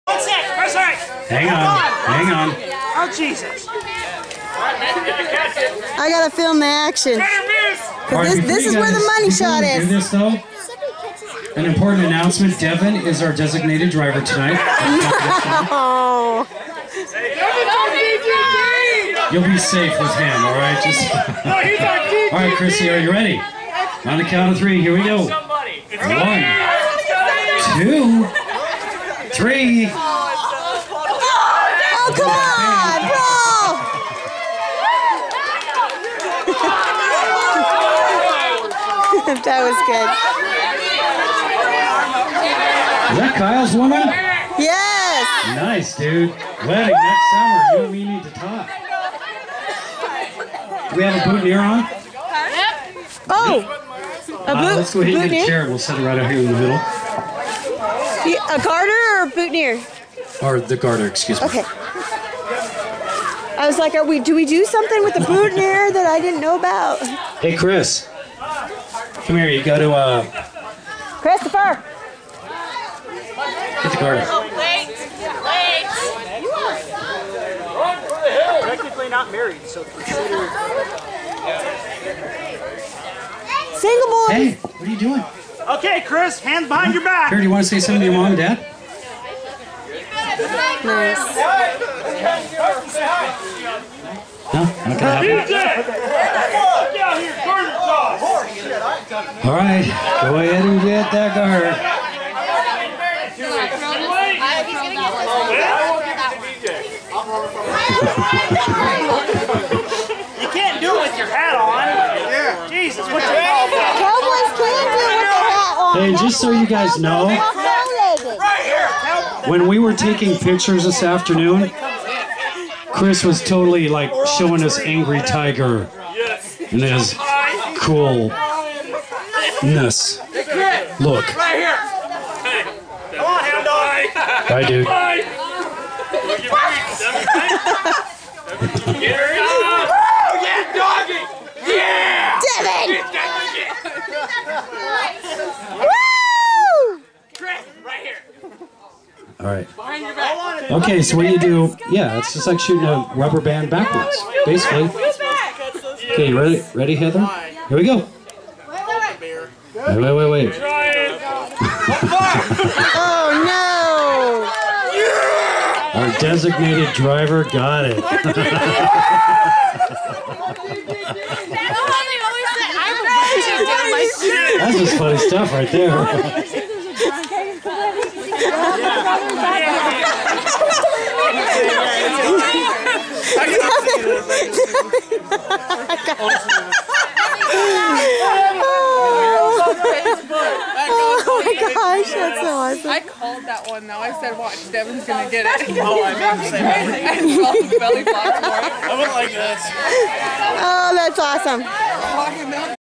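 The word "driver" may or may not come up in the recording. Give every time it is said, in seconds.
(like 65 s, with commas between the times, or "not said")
13 s, 166 s.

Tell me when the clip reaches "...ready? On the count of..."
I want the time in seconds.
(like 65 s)
23 s.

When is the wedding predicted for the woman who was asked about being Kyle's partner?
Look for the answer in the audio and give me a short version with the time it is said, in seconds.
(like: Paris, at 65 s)
next summer, at 46 s.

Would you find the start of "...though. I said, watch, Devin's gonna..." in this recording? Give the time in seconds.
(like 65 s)
193 s.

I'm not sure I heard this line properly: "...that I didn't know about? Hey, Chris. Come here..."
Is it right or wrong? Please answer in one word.
right.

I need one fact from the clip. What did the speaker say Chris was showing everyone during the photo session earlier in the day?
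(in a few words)
Angry Tiger.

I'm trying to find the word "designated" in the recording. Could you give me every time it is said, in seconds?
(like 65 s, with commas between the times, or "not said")
13 s, 166 s.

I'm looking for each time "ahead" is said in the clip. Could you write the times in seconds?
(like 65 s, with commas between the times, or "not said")
55 s, 100 s.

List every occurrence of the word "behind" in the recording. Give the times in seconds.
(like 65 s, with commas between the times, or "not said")
86 s, 149 s.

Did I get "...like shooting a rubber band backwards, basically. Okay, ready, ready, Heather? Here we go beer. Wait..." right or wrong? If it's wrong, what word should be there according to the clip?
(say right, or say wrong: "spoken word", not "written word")
right.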